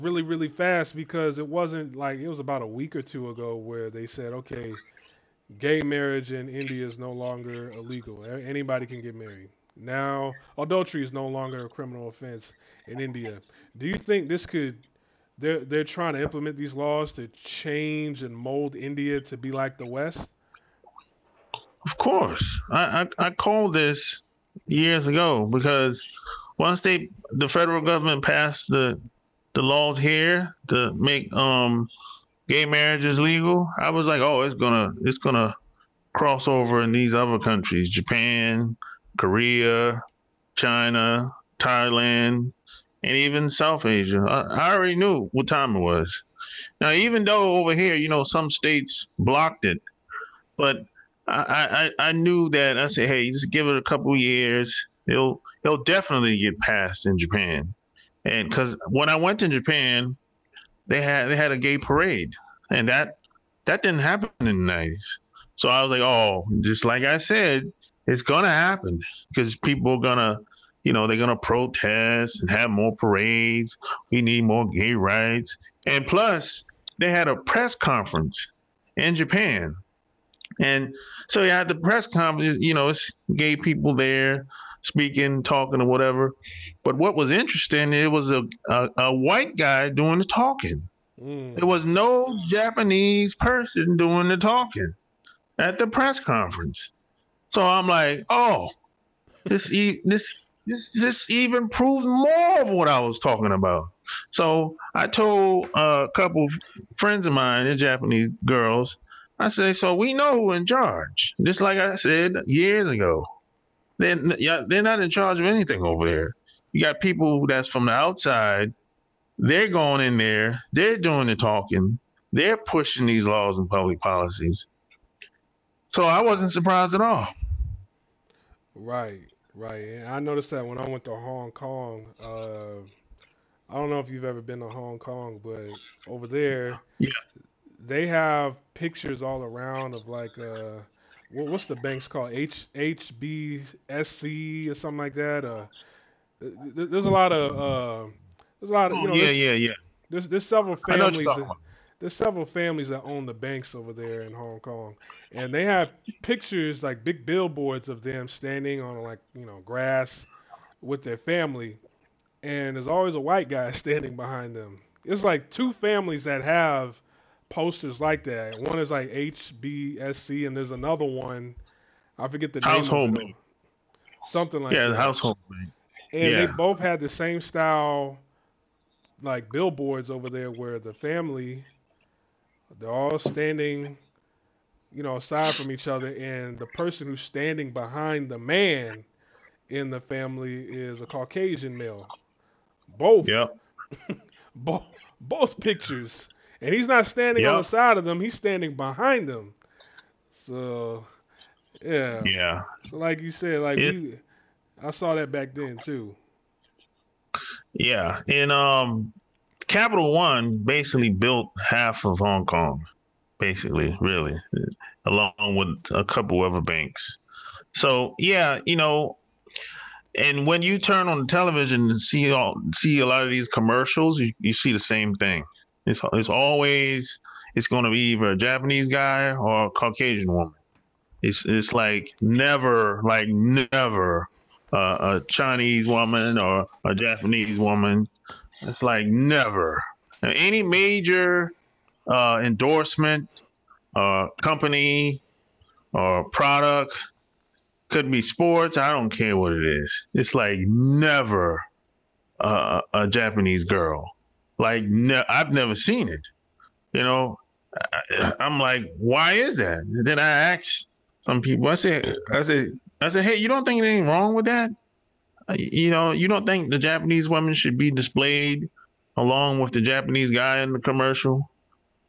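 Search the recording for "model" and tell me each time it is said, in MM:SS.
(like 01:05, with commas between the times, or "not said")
not said.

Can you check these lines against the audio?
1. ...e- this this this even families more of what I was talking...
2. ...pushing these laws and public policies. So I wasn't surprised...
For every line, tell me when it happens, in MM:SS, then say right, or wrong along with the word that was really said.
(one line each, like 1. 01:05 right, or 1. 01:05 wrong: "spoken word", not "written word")
1. 01:39 wrong: "proves", not "families"
2. 02:02 right.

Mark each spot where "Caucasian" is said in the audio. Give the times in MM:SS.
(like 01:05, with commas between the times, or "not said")
03:11, 03:49.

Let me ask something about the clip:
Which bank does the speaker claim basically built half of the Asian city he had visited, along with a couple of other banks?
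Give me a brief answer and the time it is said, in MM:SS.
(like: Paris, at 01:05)
Capital One, at 03:29.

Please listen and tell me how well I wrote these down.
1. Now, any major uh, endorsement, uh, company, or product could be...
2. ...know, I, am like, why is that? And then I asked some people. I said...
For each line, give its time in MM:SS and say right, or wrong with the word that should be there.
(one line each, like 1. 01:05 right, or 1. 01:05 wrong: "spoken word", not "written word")
1. 04:00 right
2. 04:17 right.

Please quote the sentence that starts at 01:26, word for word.
But what was interesting, it was a, a, a white guy doing the talking.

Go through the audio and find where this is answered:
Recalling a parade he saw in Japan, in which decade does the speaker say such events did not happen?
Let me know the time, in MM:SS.
01:04.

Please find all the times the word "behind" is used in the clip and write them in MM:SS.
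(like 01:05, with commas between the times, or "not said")
02:44, 03:07, 03:18.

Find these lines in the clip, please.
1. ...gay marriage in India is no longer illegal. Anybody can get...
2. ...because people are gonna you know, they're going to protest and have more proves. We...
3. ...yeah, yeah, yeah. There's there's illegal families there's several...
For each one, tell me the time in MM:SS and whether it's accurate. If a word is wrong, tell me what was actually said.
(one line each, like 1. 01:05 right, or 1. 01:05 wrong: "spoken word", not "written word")
1. 00:05 right
2. 01:09 wrong: "parades", not "proves"
3. 02:29 wrong: "several", not "illegal".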